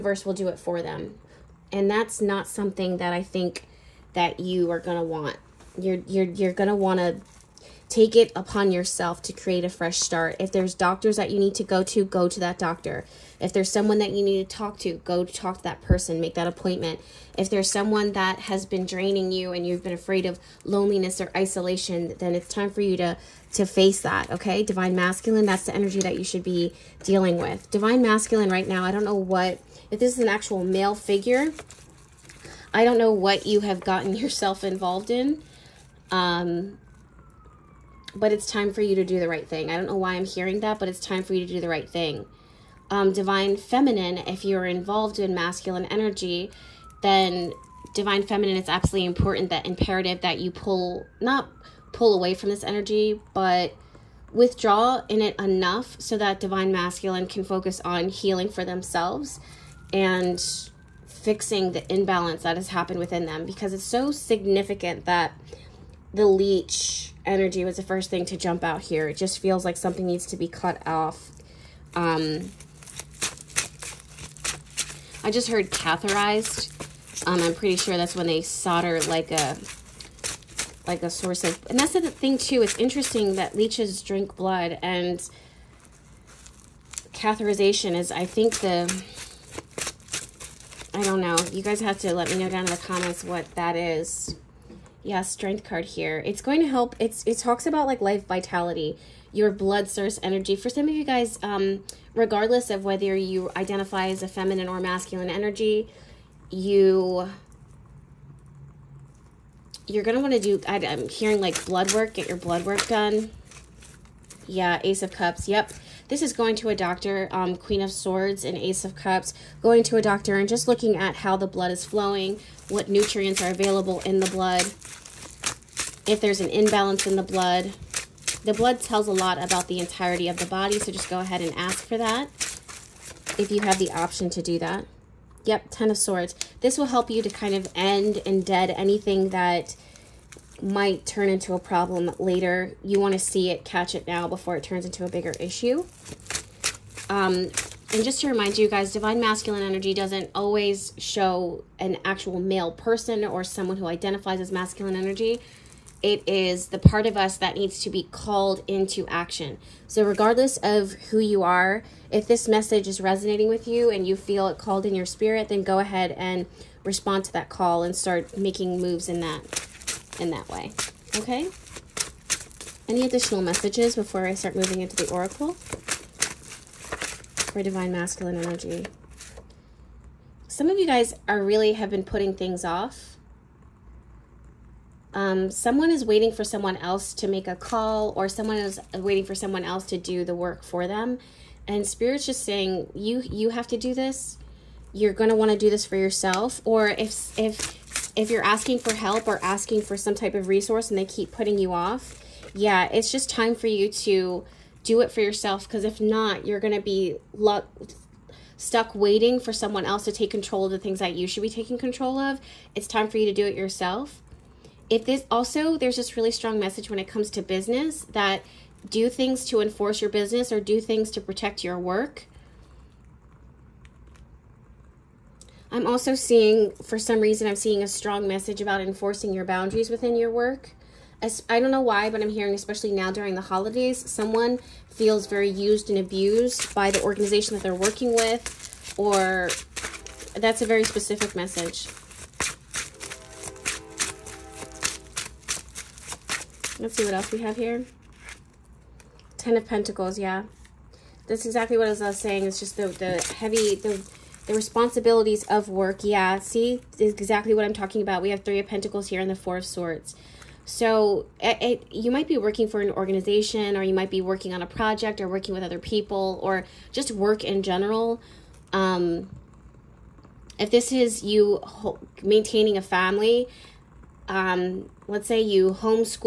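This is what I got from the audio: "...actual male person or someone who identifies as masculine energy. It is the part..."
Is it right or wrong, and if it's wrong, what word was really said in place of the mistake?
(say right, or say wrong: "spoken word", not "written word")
right.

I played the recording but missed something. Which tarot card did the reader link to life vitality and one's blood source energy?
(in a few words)
Strength.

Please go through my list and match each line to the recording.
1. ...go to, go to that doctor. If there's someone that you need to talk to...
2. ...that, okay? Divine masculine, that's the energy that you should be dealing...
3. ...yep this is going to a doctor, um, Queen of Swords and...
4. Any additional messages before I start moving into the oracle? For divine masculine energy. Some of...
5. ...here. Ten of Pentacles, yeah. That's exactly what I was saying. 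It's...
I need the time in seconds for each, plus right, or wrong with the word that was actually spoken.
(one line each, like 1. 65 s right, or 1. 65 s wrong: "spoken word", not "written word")
1. 11 s right
2. 24 s right
3. 115 s right
4. 172 s right
5. 247 s right.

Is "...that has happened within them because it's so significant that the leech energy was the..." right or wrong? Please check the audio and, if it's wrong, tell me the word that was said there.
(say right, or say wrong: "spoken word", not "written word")
right.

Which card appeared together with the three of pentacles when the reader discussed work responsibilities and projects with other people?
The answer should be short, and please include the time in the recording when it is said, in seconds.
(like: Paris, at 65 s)
Four of Swords, at 259 s.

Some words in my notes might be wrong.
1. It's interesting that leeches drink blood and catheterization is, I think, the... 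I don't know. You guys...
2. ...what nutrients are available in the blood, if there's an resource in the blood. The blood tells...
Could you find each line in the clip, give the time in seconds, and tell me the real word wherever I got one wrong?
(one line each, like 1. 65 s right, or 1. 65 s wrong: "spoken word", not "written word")
1. 82 s right
2. 122 s wrong: "imbalance", not "resource".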